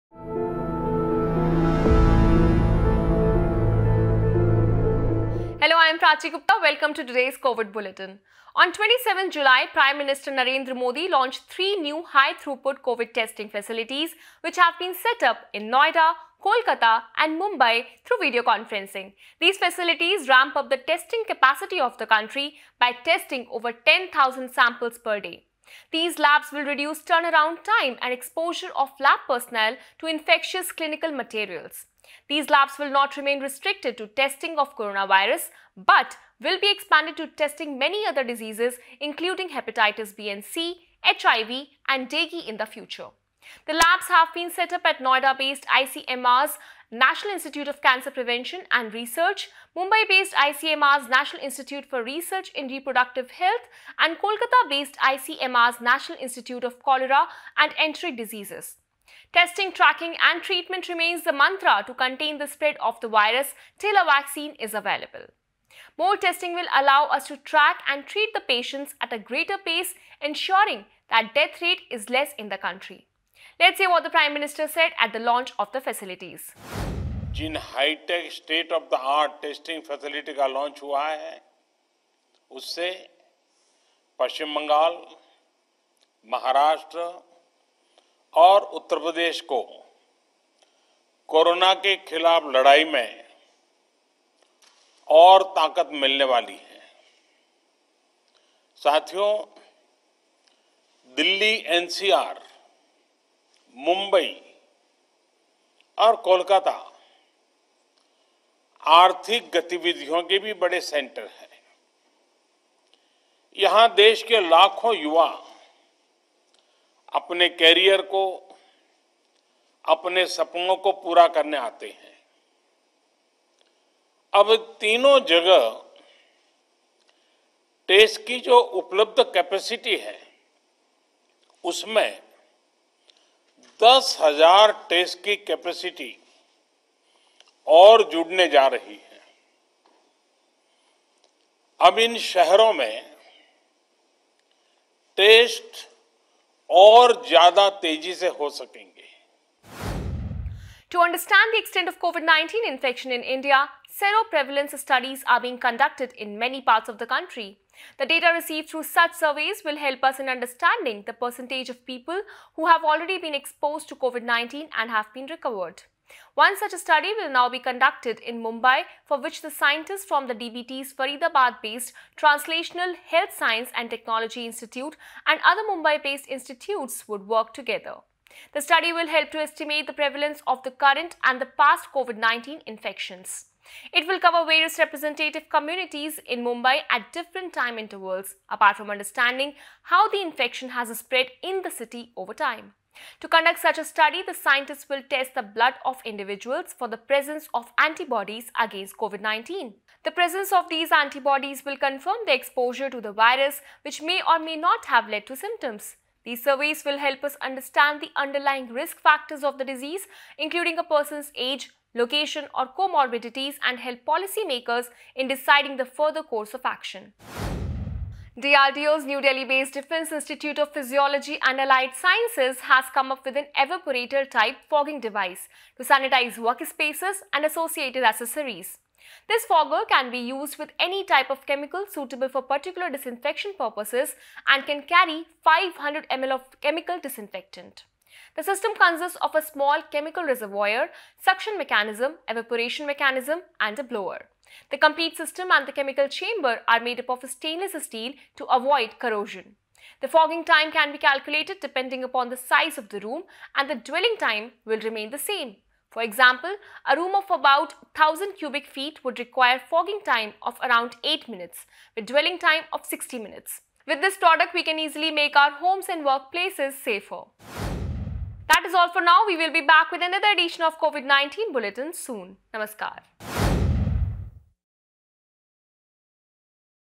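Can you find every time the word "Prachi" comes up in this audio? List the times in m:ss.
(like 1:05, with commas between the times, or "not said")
0:06.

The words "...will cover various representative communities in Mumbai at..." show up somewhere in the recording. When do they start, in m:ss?
3:04.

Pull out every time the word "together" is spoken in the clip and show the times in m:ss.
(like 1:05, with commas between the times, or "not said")
2:57.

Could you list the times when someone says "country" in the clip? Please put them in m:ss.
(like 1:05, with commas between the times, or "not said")
0:22, 1:12, 2:37.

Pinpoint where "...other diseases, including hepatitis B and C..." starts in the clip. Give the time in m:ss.
0:38.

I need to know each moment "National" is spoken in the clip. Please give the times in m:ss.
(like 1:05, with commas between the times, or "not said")
0:46, 0:51, 0:55.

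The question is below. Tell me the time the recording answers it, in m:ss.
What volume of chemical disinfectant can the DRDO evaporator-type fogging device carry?
3:55.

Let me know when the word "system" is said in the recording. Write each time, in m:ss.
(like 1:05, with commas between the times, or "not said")
3:58, 4:05.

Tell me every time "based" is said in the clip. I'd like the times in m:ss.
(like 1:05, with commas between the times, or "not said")
0:44, 0:49, 0:54, 2:50, 2:55, 3:39.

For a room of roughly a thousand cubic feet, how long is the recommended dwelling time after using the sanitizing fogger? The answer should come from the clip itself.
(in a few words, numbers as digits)
60 minutes.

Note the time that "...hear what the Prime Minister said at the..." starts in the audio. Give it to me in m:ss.
1:13.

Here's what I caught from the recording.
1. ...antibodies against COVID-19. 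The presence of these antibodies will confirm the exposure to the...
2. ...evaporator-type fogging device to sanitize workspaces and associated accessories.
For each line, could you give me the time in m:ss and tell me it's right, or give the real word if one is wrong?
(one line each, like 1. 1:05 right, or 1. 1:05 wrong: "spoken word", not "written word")
1. 3:17 right
2. 3:43 right.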